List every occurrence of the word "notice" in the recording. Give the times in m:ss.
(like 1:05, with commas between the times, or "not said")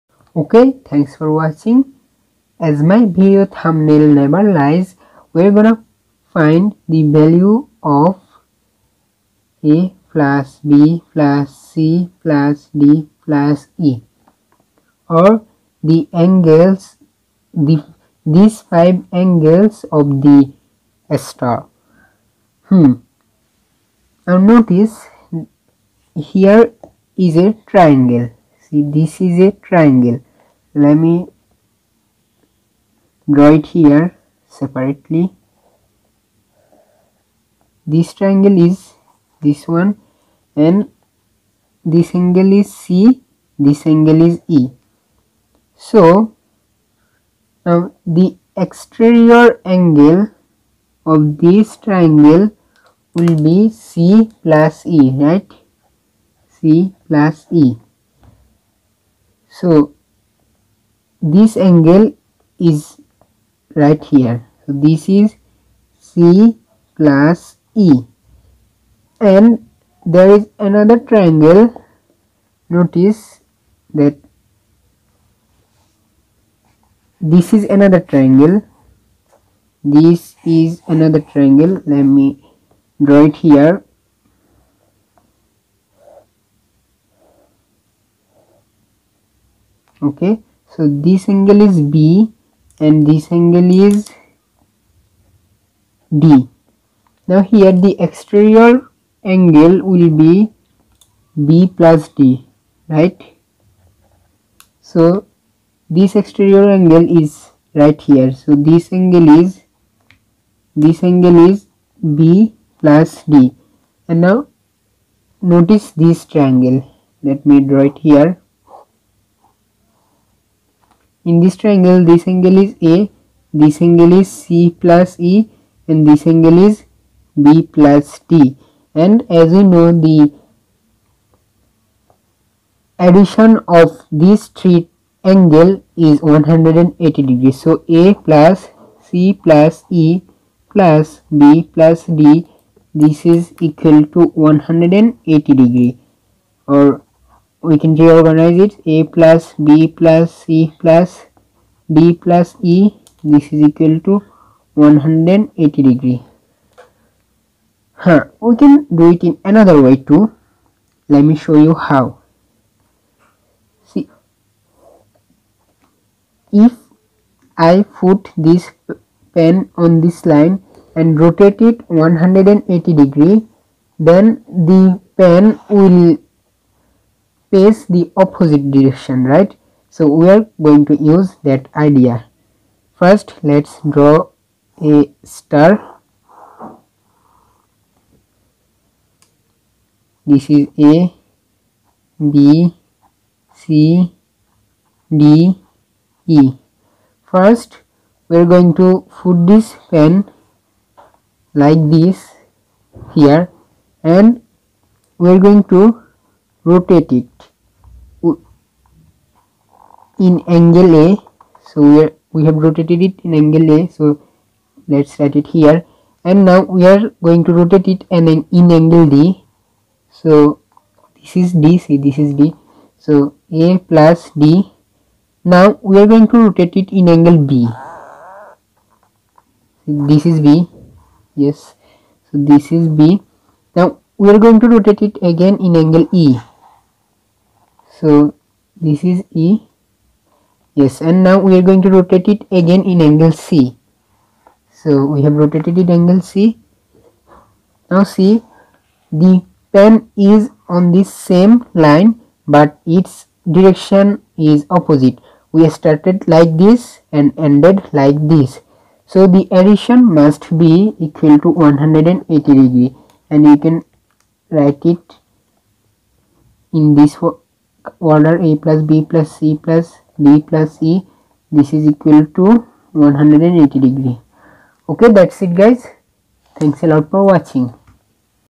0:24, 1:12, 1:55.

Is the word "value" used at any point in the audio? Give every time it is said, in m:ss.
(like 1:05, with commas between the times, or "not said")
0:07.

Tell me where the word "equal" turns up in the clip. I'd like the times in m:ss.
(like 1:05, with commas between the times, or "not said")
2:23, 2:33, 4:20, 4:31.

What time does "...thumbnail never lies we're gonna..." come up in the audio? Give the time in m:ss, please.
0:03.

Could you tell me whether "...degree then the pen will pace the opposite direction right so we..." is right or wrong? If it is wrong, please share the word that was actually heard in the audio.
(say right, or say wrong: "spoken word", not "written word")
right.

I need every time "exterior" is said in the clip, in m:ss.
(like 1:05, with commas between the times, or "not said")
0:48, 1:38, 1:46.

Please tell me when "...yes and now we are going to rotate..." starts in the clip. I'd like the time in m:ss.
4:00.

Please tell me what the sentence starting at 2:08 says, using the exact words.
And as you know, the addition of these three angle is 180 degrees.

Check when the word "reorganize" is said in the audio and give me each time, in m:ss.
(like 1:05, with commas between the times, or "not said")
2:27.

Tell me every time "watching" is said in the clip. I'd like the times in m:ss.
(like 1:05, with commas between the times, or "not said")
0:01, 4:37.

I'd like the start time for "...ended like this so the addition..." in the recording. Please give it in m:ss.
4:17.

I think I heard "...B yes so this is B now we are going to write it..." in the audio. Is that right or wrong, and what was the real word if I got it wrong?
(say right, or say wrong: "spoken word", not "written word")
wrong: "rotate", not "write".